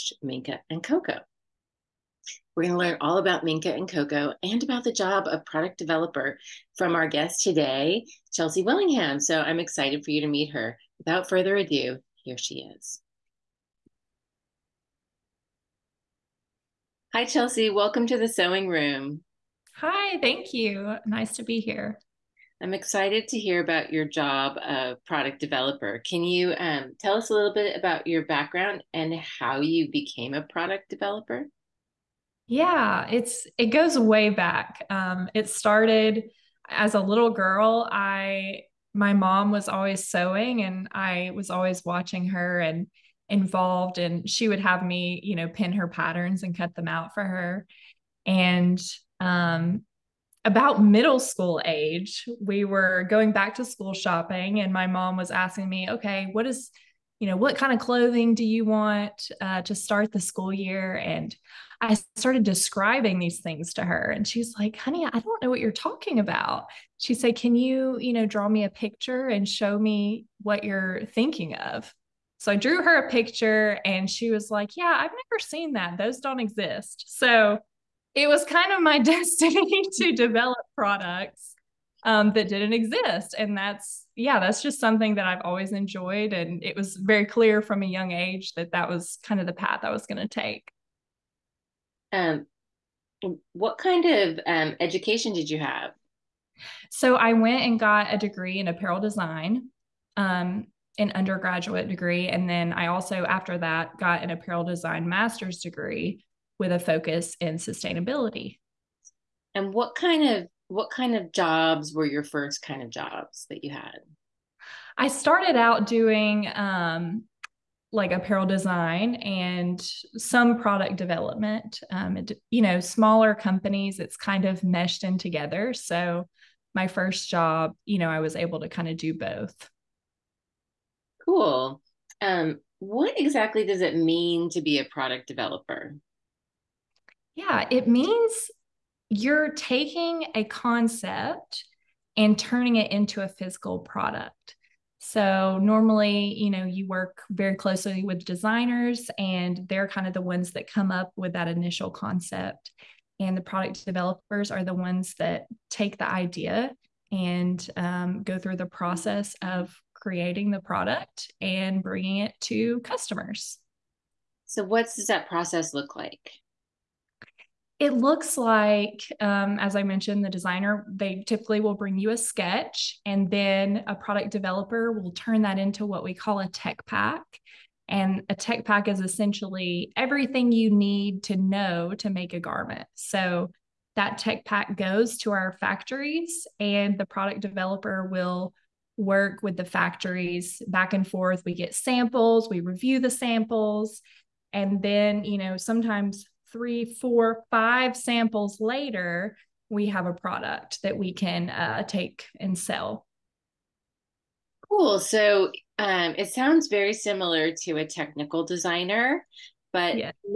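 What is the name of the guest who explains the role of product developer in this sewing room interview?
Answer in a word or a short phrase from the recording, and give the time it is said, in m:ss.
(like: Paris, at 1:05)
Chelsea Willingham, at 0:08.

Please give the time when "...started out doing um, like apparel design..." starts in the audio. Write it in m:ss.
1:55.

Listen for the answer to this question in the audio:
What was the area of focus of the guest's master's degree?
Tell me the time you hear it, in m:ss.
1:47.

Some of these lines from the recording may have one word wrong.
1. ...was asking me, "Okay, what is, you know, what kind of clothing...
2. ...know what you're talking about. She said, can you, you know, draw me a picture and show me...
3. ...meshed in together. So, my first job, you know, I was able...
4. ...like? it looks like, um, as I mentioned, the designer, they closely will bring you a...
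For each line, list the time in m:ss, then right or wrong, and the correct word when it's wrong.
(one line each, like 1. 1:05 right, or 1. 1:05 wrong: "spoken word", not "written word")
1. 0:55 right
2. 1:05 right
3. 2:04 right
4. 2:45 wrong: "typically", not "closely".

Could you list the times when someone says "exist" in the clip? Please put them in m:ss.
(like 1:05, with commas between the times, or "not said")
1:16, 1:22.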